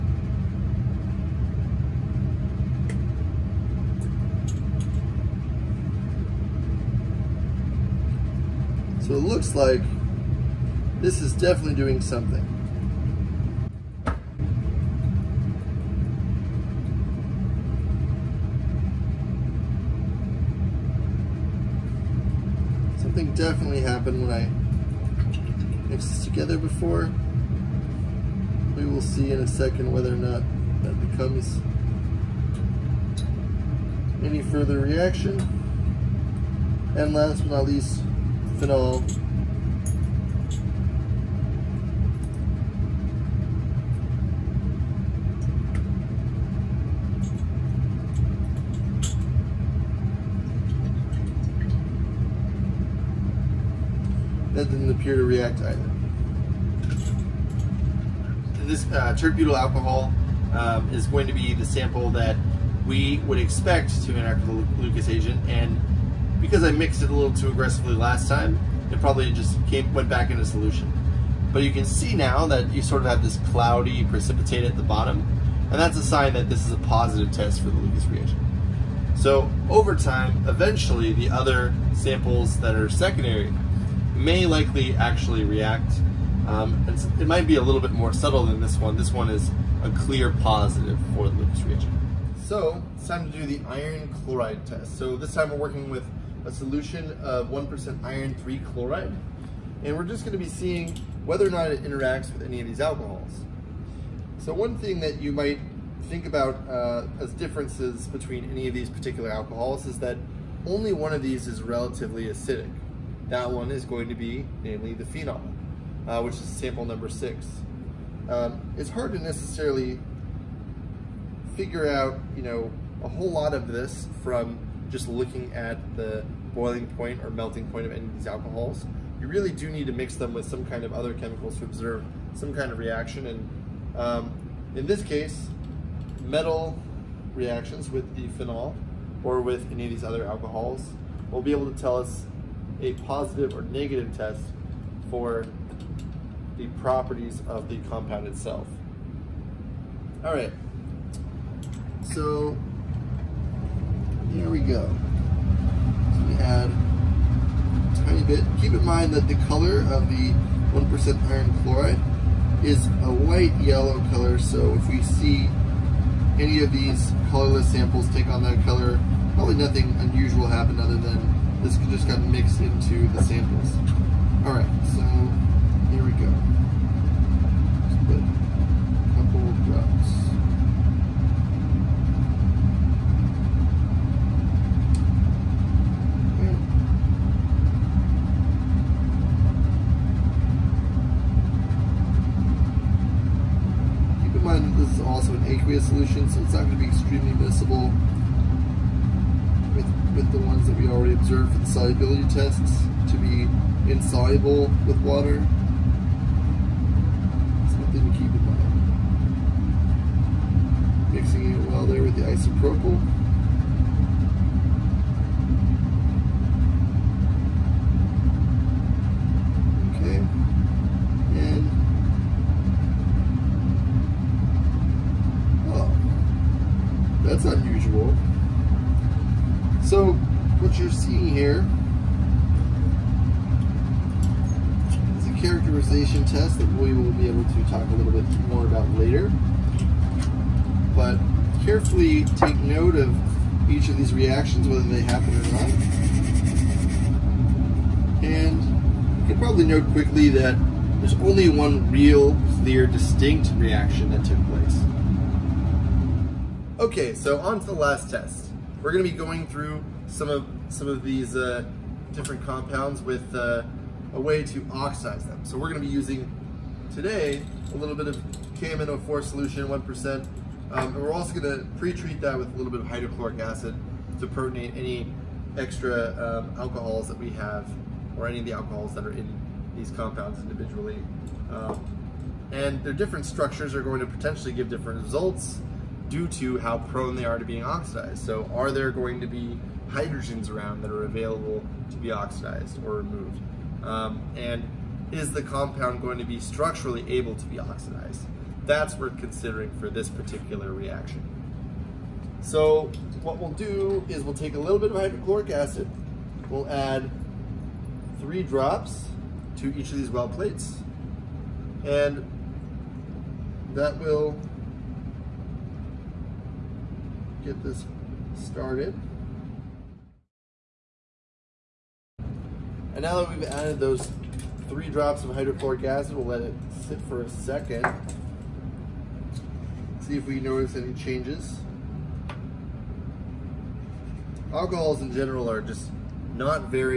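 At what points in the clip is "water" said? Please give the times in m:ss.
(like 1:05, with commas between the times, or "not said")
3:25.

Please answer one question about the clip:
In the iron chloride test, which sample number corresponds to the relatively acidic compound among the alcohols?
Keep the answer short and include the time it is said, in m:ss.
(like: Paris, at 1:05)
6, at 1:57.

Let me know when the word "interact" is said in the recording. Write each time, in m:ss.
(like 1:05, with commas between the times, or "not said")
1:04, 1:41.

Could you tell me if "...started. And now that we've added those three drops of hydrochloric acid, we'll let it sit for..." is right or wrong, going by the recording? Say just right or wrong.
right.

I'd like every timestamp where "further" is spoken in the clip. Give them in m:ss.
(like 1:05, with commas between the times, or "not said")
0:34.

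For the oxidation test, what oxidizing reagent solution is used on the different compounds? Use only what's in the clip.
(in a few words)
KMnO4.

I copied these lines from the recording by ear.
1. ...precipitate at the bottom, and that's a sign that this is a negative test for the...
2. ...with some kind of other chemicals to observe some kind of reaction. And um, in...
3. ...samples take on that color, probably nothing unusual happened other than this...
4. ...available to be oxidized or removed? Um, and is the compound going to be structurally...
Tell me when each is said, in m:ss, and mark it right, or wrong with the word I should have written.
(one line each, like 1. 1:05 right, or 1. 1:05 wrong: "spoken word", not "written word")
1. 1:14 wrong: "positive", not "negative"
2. 2:10 right
3. 2:47 right
4. 4:51 right.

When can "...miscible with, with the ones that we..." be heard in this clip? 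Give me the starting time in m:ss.
3:17.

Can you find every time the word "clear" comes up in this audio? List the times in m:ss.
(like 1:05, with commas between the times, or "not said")
1:29, 4:12.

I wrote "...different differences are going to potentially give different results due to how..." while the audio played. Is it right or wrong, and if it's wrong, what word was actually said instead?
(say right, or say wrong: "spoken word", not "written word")
wrong: "structures", not "differences".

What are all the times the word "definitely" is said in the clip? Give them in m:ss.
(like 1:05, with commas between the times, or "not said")
0:11, 0:23.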